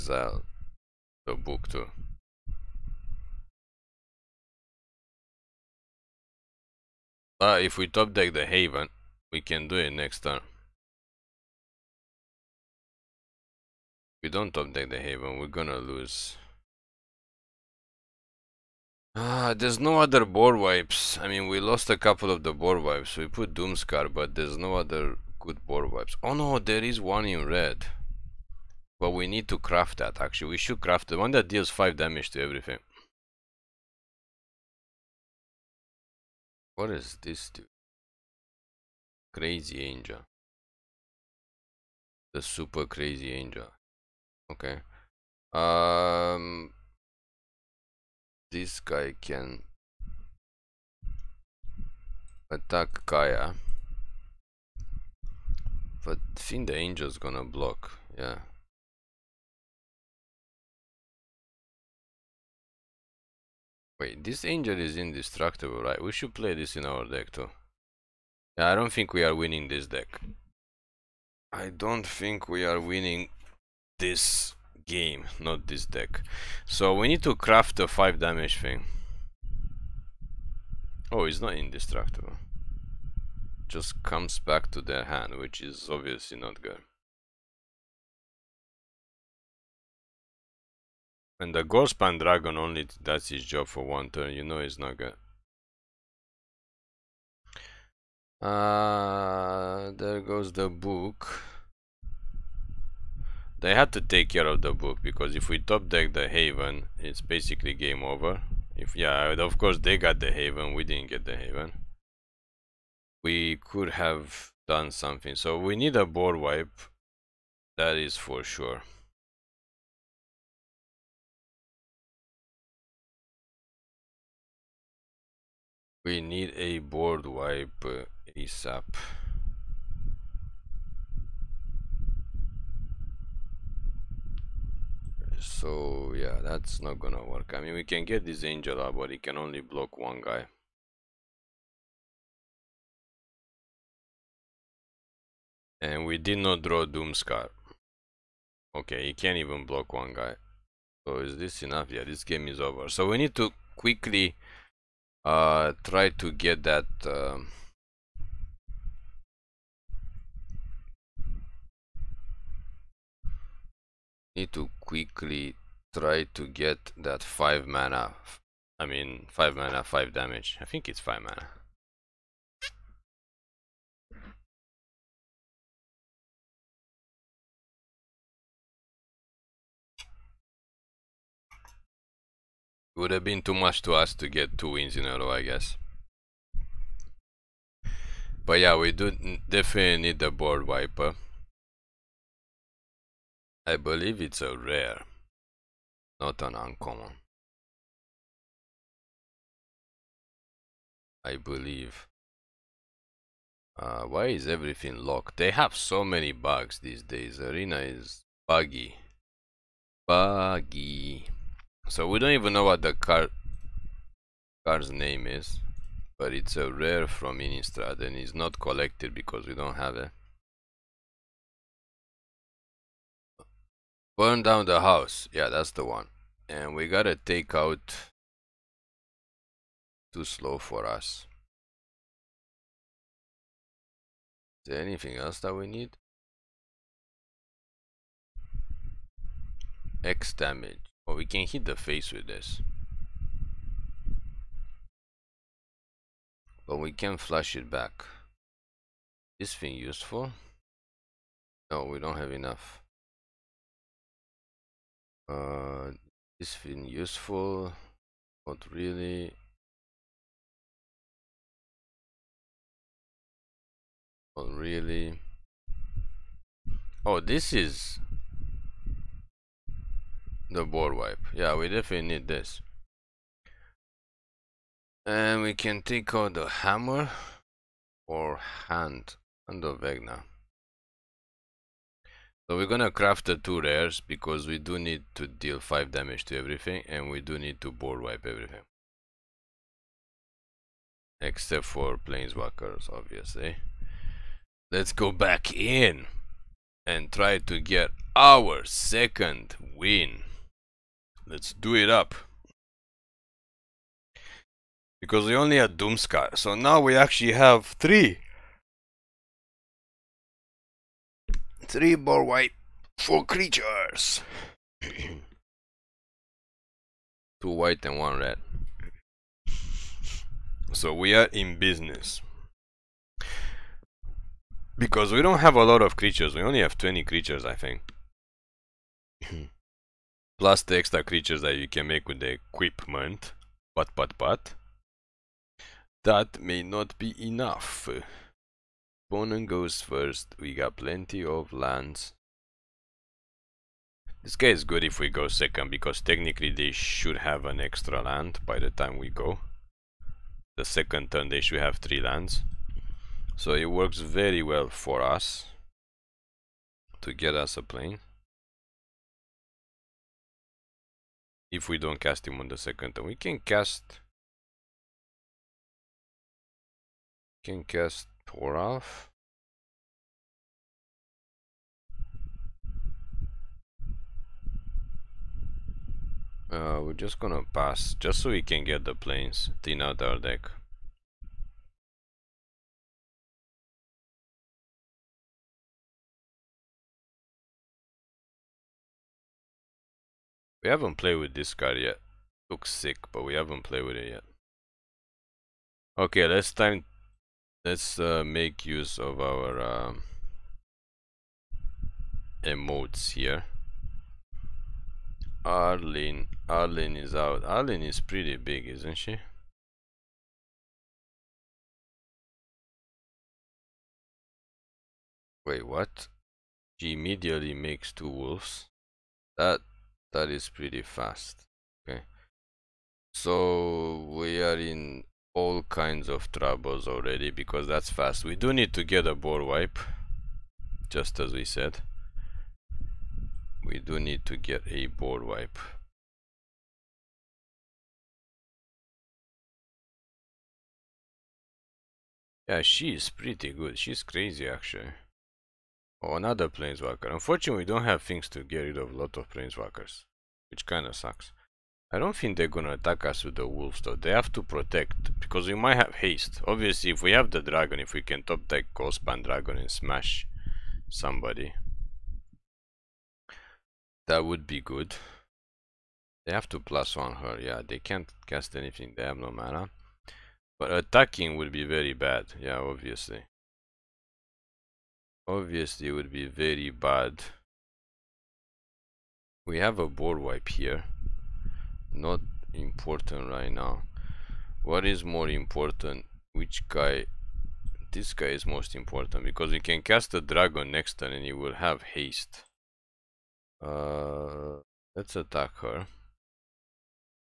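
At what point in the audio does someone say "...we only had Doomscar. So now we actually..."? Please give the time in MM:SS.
05:05.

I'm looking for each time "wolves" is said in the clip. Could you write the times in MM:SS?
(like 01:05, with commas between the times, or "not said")
06:58, 07:33.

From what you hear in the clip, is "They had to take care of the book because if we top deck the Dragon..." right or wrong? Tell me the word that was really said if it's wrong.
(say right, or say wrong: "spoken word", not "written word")
wrong: "Haven", not "Dragon".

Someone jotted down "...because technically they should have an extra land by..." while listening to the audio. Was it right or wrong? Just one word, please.
right.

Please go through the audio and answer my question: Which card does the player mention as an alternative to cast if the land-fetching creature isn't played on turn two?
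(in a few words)
Toralf.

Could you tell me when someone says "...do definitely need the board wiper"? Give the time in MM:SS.
03:08.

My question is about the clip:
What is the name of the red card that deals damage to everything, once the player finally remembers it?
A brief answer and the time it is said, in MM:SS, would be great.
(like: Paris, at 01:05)
Burn Down the House, at 03:44.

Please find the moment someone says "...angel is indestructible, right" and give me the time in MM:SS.
01:04.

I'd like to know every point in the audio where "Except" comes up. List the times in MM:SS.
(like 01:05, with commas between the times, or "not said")
04:51.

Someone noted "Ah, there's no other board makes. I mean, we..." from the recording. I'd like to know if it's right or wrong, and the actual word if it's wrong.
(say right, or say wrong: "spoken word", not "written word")
wrong: "wipes", not "makes".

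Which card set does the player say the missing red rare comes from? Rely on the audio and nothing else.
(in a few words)
Innistrad.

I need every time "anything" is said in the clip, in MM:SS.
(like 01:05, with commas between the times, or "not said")
03:54, 07:48.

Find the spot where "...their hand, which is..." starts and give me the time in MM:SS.
01:24.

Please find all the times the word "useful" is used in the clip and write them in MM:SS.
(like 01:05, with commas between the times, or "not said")
04:09, 04:16.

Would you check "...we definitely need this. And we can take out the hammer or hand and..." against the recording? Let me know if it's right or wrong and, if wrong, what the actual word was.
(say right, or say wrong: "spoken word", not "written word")
right.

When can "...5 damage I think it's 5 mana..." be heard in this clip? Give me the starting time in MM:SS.
02:49.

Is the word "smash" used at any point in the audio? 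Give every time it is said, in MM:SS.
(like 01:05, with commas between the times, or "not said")
07:39.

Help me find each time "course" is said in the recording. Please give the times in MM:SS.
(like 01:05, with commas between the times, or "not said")
01:49.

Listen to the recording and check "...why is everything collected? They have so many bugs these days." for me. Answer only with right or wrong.
wrong.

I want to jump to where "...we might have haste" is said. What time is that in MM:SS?
07:35.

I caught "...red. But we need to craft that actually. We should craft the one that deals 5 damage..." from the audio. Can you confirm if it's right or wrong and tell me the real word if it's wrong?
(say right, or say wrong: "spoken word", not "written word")
right.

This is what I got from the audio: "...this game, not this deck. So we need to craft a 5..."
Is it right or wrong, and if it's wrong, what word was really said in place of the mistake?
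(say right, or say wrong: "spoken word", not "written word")
right.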